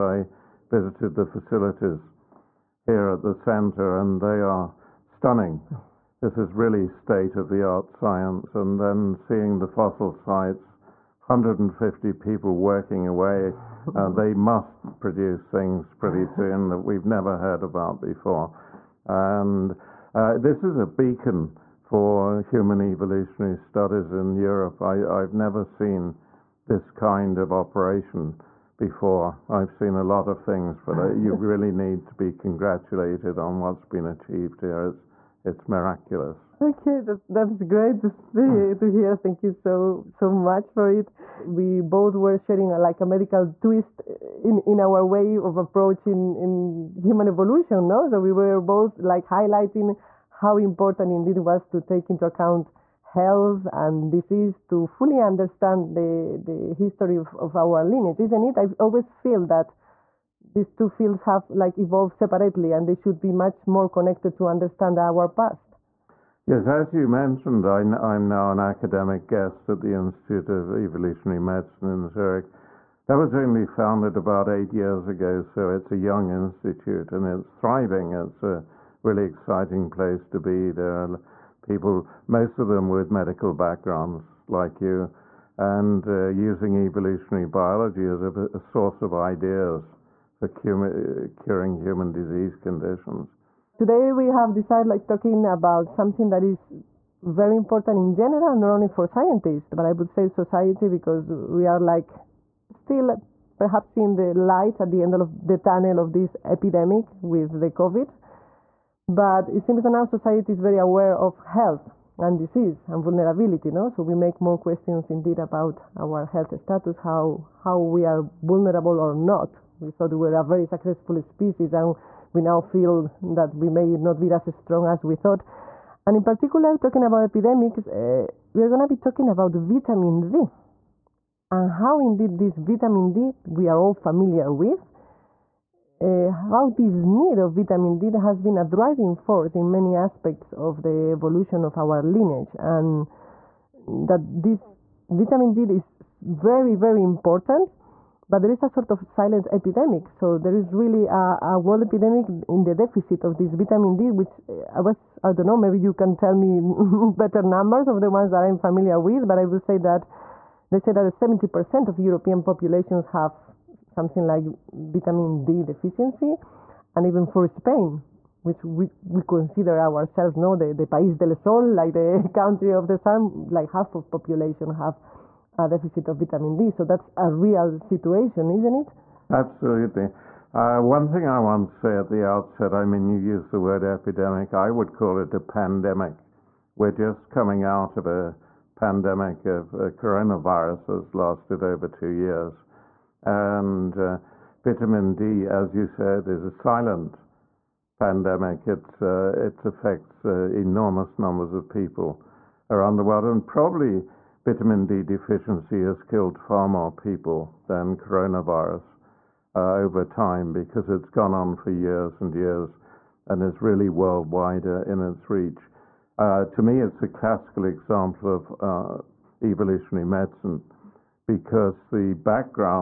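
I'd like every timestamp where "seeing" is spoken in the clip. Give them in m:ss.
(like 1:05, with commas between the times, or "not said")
0:09, 1:43.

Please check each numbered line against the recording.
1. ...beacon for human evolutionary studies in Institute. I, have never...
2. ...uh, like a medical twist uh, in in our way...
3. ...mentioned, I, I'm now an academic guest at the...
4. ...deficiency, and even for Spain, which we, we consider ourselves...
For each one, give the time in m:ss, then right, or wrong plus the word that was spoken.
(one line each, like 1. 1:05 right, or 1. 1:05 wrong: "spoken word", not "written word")
1. 0:20 wrong: "Europe", not "Institute"
2. 0:42 right
3. 1:07 right
4. 2:45 right.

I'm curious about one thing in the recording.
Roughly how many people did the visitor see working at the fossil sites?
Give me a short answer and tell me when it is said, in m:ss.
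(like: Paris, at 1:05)
150, at 0:11.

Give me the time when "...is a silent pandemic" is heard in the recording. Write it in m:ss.
3:16.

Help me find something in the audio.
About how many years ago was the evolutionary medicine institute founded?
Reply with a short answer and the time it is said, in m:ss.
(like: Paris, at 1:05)
8, at 1:14.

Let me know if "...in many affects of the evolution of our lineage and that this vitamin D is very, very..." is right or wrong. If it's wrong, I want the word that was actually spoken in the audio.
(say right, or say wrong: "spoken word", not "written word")
wrong: "aspects", not "affects".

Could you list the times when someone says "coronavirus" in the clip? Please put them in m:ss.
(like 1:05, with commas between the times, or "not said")
3:09, 3:27.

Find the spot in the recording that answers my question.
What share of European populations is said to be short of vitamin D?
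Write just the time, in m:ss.
2:41.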